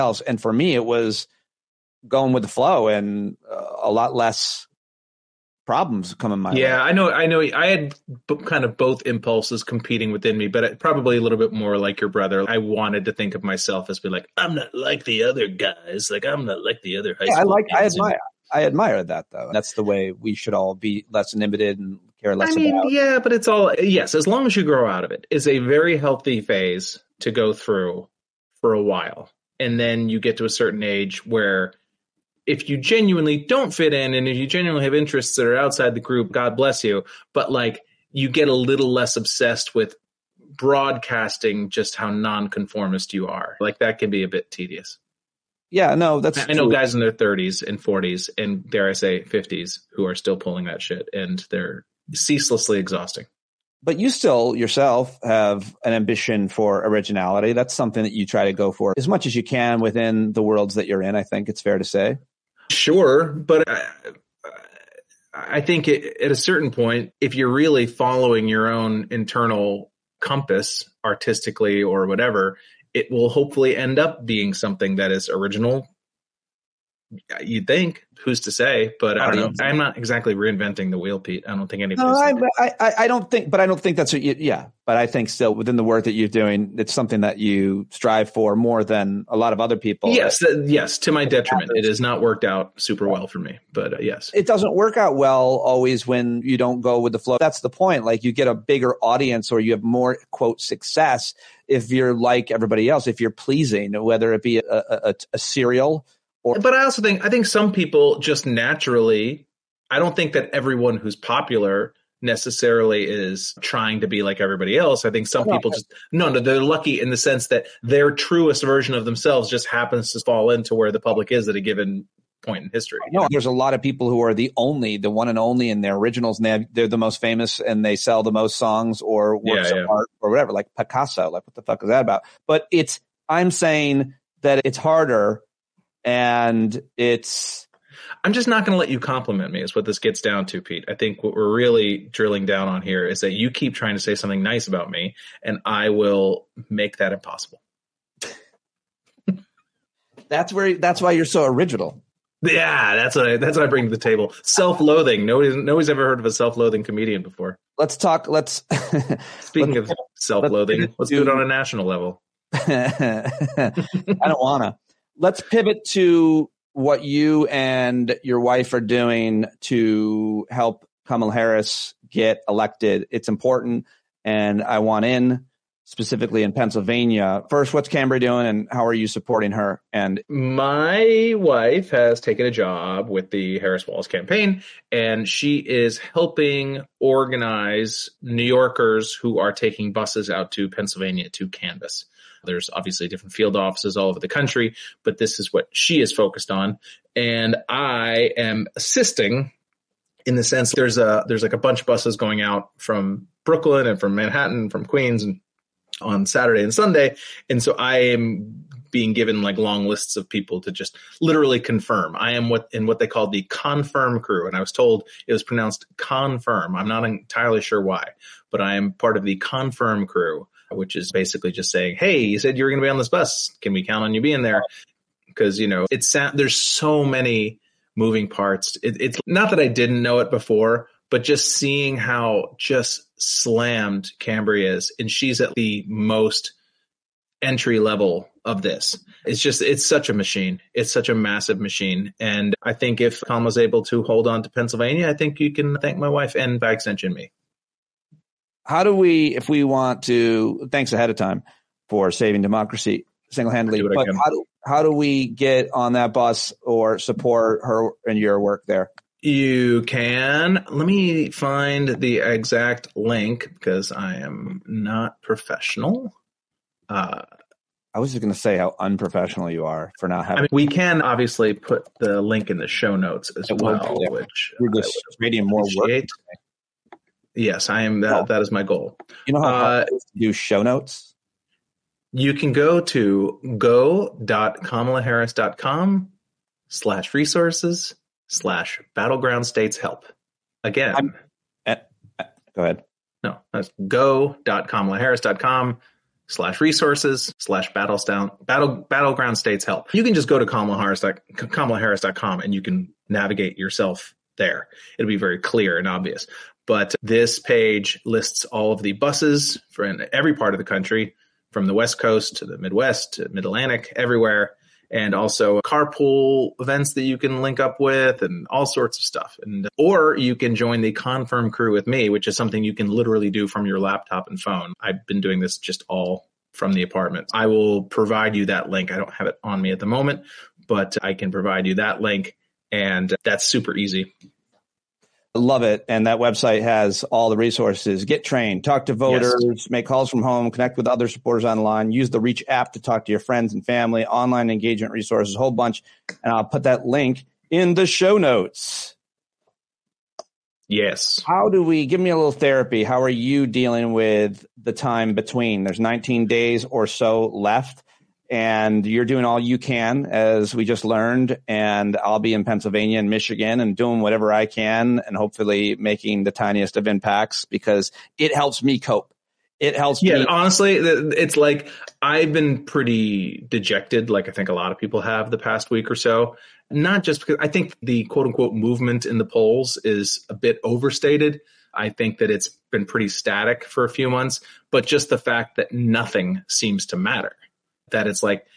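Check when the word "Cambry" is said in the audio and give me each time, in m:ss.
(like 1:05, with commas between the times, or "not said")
2:57, 3:54.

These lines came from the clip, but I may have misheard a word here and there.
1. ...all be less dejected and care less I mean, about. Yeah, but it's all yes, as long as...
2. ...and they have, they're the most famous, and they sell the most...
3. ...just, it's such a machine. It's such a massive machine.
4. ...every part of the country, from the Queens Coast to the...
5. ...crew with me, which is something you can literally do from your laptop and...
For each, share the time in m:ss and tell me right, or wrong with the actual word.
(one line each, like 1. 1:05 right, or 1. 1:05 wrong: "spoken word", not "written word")
1. 0:20 wrong: "inhibited", not "dejected"
2. 2:06 right
3. 3:59 right
4. 5:10 wrong: "West", not "Queens"
5. 5:21 right.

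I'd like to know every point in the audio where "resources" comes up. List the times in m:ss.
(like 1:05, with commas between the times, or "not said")
4:47, 4:56, 5:37, 5:44.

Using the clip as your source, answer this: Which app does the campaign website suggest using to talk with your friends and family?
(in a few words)
Reach.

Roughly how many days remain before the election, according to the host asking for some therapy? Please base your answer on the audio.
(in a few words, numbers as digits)
19.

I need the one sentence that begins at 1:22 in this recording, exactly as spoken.
No, I, I, I, don't think, but I don't think that's what you, yeah.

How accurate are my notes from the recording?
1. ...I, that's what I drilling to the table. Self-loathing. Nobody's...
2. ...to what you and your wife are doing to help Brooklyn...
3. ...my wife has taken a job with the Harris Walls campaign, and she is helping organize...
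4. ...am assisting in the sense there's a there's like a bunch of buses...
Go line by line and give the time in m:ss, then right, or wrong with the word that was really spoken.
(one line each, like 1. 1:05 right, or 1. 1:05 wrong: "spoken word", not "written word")
1. 2:33 wrong: "bring", not "drilling"
2. 2:45 wrong: "Kamala", not "Brooklyn"
3. 3:00 right
4. 3:18 right.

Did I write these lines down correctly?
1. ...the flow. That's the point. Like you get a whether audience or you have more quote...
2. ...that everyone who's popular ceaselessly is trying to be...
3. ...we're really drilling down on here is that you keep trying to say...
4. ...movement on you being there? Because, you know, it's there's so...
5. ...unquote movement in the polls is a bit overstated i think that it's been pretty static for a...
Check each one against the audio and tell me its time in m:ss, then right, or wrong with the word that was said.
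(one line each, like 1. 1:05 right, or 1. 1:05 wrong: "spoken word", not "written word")
1. 1:37 wrong: "bigger", not "whether"
2. 1:50 wrong: "necessarily", not "ceaselessly"
3. 2:21 right
4. 3:43 wrong: "count", not "movement"
5. 6:18 right.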